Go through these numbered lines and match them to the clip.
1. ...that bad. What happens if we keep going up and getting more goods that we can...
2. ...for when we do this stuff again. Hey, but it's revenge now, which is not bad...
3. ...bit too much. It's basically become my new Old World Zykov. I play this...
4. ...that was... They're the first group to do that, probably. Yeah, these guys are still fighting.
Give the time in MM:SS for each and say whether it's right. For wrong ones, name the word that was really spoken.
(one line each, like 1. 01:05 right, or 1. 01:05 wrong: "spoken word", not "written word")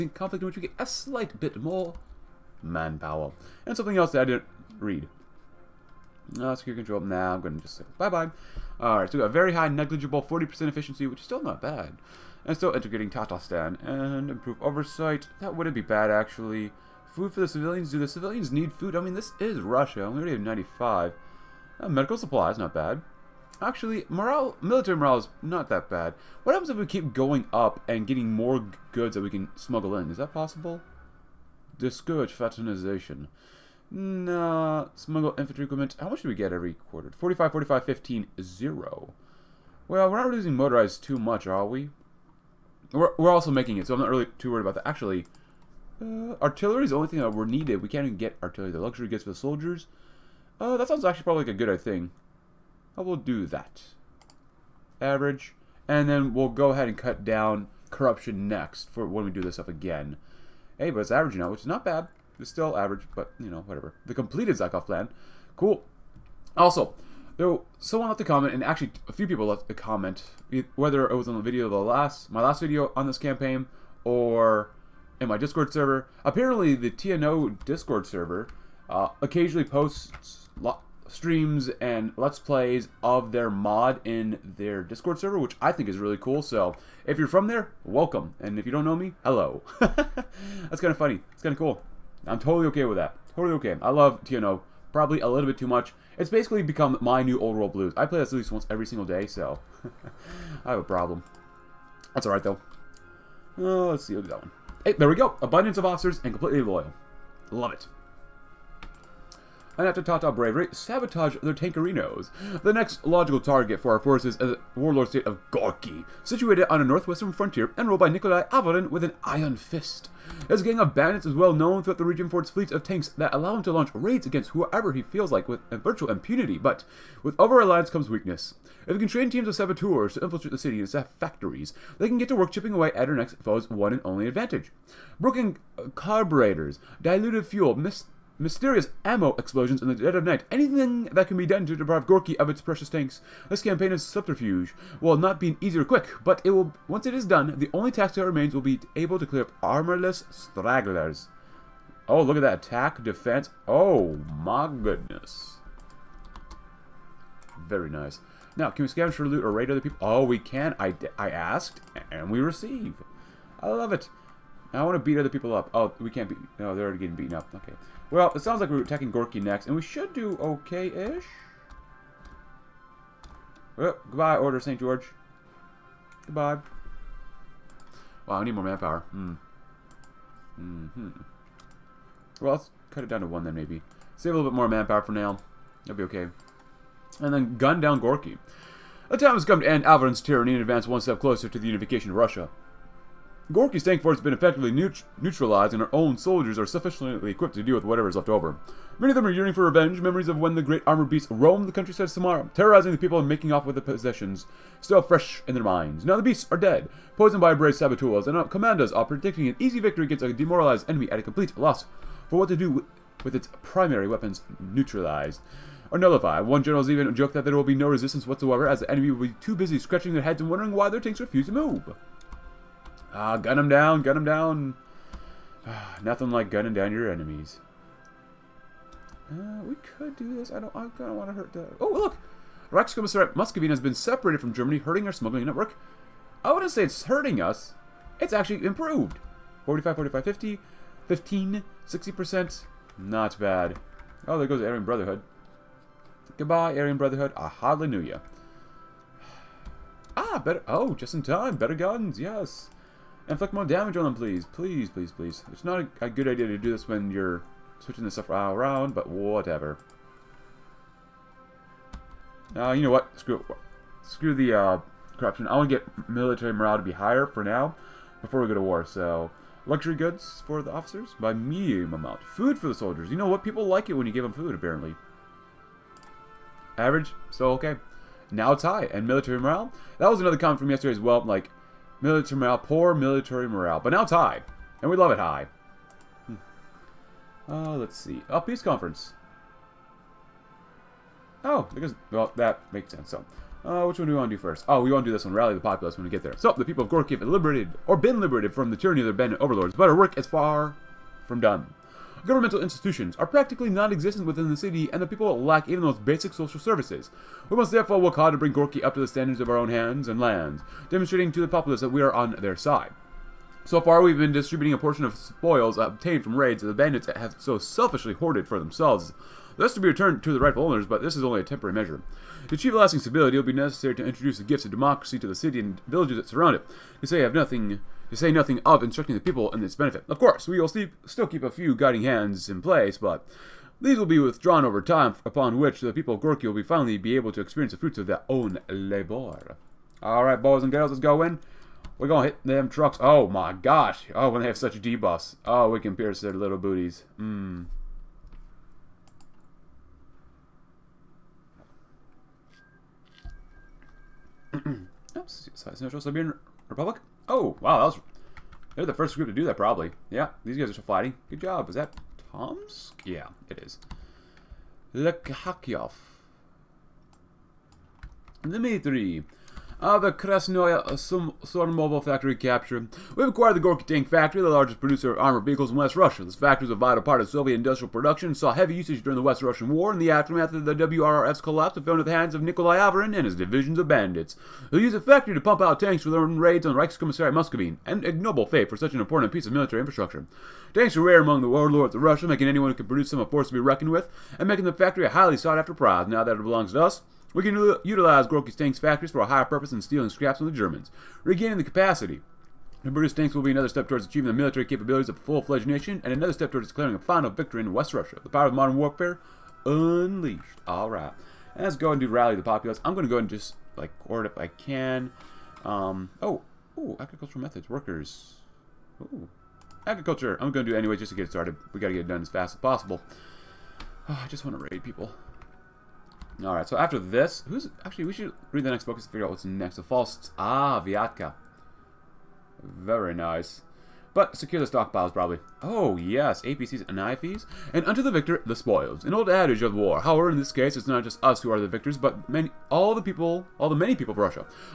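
1. 00:25 right
2. 00:58 wrong: "average", not "revenge"
3. 01:35 wrong: "Blues", not "Zykov"
4. 05:57 right.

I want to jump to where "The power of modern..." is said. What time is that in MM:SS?
06:48.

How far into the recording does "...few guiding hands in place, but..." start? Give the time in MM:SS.
05:31.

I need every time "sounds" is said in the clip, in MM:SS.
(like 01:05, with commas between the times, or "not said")
00:50, 02:48.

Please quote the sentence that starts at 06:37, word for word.
We can utilize Gorky's tanks factories for a higher purpose than stealing scraps from the Germans.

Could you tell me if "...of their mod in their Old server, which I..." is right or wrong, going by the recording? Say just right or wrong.
wrong.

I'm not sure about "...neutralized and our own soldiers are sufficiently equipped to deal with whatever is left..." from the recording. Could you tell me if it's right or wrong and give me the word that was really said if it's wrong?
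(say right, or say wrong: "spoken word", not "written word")
right.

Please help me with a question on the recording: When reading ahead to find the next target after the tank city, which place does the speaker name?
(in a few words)
Viatka.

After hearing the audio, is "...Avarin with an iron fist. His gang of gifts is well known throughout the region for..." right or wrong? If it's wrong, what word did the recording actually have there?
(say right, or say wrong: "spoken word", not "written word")
wrong: "bandits", not "gifts".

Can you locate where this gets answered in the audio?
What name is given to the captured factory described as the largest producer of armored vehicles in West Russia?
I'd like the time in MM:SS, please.
06:10.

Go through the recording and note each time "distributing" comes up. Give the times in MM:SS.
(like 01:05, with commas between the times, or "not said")
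05:14.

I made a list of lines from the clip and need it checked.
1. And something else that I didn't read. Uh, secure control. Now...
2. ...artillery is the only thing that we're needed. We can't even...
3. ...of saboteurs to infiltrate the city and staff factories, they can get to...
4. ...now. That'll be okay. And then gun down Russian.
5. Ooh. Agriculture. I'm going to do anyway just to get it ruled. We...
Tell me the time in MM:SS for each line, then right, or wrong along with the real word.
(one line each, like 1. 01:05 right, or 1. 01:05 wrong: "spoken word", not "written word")
1. 00:03 right
2. 00:46 right
3. 02:09 right
4. 03:05 wrong: "Gorky", not "Russian"
5. 06:58 wrong: "started", not "ruled".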